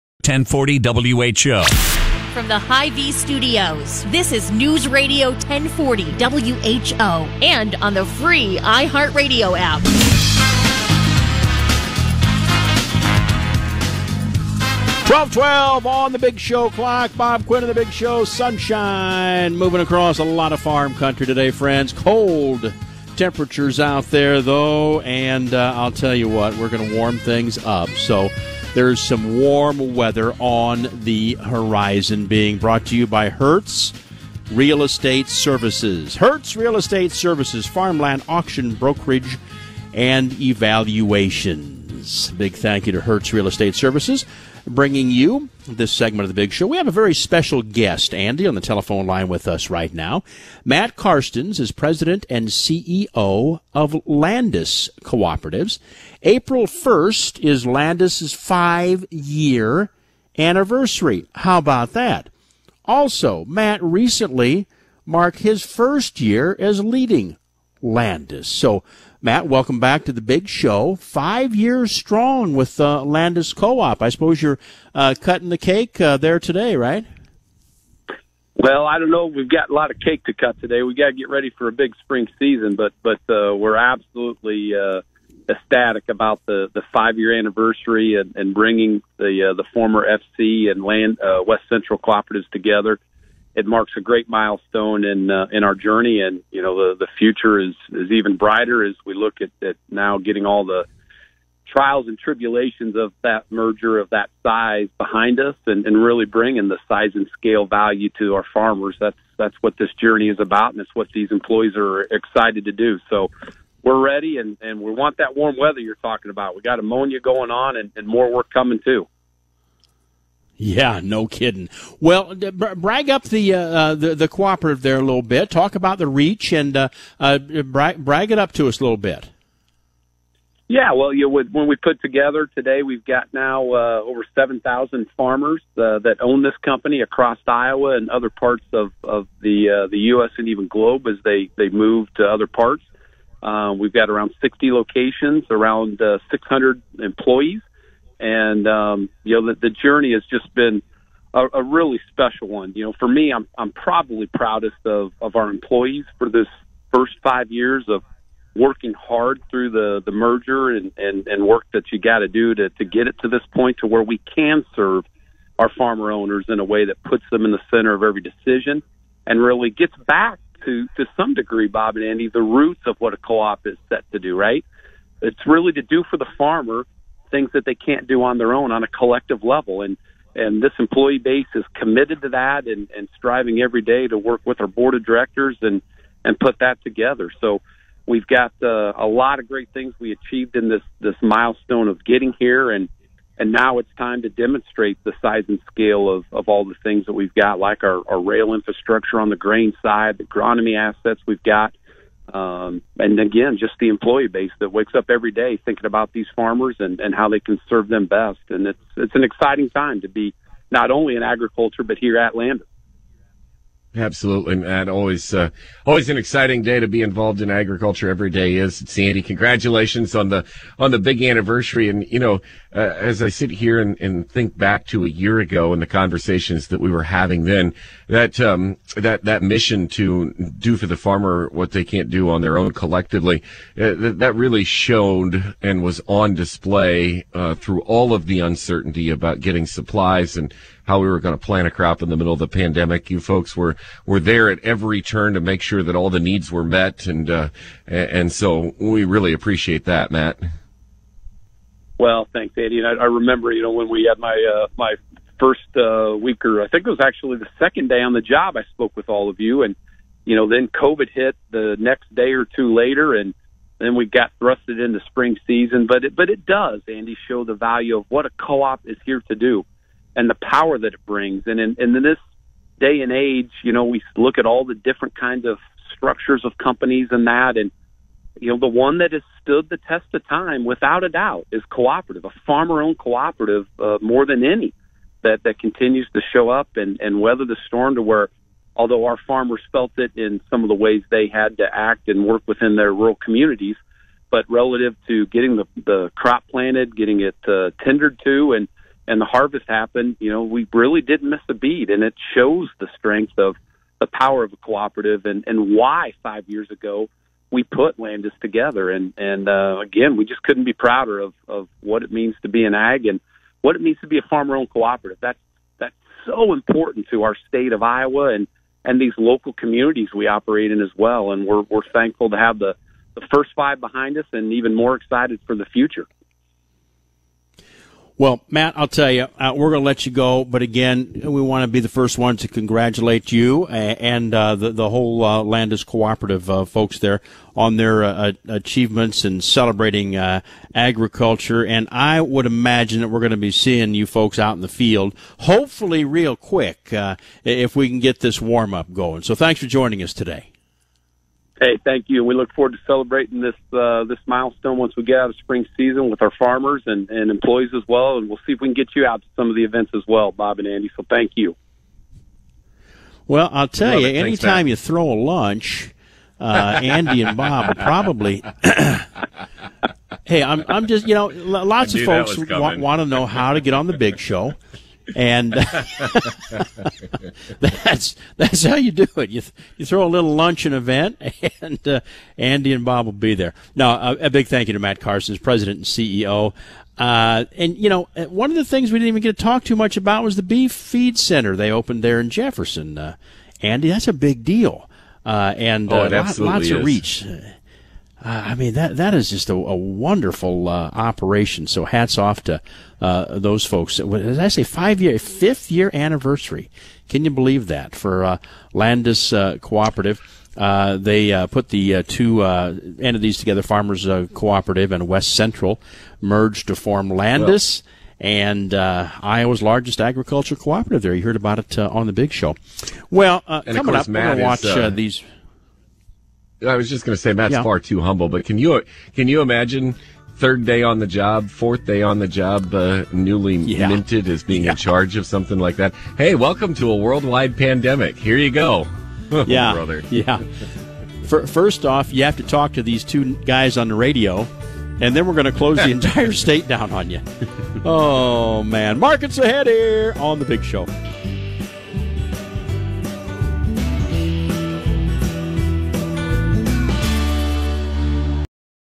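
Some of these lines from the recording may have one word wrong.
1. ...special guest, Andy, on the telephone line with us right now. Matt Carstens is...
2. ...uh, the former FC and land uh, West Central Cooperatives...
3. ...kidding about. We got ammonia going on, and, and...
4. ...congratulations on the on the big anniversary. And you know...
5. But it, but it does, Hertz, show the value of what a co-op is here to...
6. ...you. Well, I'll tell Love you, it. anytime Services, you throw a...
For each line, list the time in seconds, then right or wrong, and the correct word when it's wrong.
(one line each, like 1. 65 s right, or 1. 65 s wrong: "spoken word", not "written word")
1. 47 s right
2. 89 s right
3. 115 s wrong: "talking", not "kidding"
4. 219 s right
5. 265 s wrong: "Andy", not "Hertz"
6. 361 s wrong: "Thanks", not "Services".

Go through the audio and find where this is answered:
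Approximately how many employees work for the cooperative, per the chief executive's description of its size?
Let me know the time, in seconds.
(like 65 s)
146 s.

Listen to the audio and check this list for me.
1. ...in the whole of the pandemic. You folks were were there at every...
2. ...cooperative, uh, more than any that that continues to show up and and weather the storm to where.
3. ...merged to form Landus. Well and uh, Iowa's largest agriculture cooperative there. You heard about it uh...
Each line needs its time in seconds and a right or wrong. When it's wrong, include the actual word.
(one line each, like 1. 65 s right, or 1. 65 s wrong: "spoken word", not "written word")
1. 242 s wrong: "middle", not "whole"
2. 282 s right
3. 416 s right.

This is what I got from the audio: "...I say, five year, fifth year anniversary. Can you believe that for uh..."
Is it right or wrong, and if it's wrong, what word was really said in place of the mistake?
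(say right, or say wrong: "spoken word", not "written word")
right.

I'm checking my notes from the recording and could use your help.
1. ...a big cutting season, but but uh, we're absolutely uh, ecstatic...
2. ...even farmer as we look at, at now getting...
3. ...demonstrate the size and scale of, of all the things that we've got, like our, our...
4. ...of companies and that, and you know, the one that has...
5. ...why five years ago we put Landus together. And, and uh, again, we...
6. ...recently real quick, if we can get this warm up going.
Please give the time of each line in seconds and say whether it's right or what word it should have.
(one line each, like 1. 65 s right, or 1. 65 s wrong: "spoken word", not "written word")
1. 81 s wrong: "spring", not "cutting"
2. 98 s wrong: "brighter", not "farmer"
3. 194 s right
4. 276 s right
5. 305 s right
6. 345 s wrong: "hopefully", not "recently".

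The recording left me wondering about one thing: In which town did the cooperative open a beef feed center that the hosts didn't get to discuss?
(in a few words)
Jefferson.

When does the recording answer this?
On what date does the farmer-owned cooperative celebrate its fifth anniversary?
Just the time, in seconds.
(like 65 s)
56 s.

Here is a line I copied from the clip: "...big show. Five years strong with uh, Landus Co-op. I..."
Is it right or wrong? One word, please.
right.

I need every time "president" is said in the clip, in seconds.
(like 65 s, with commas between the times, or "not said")
51 s, 385 s.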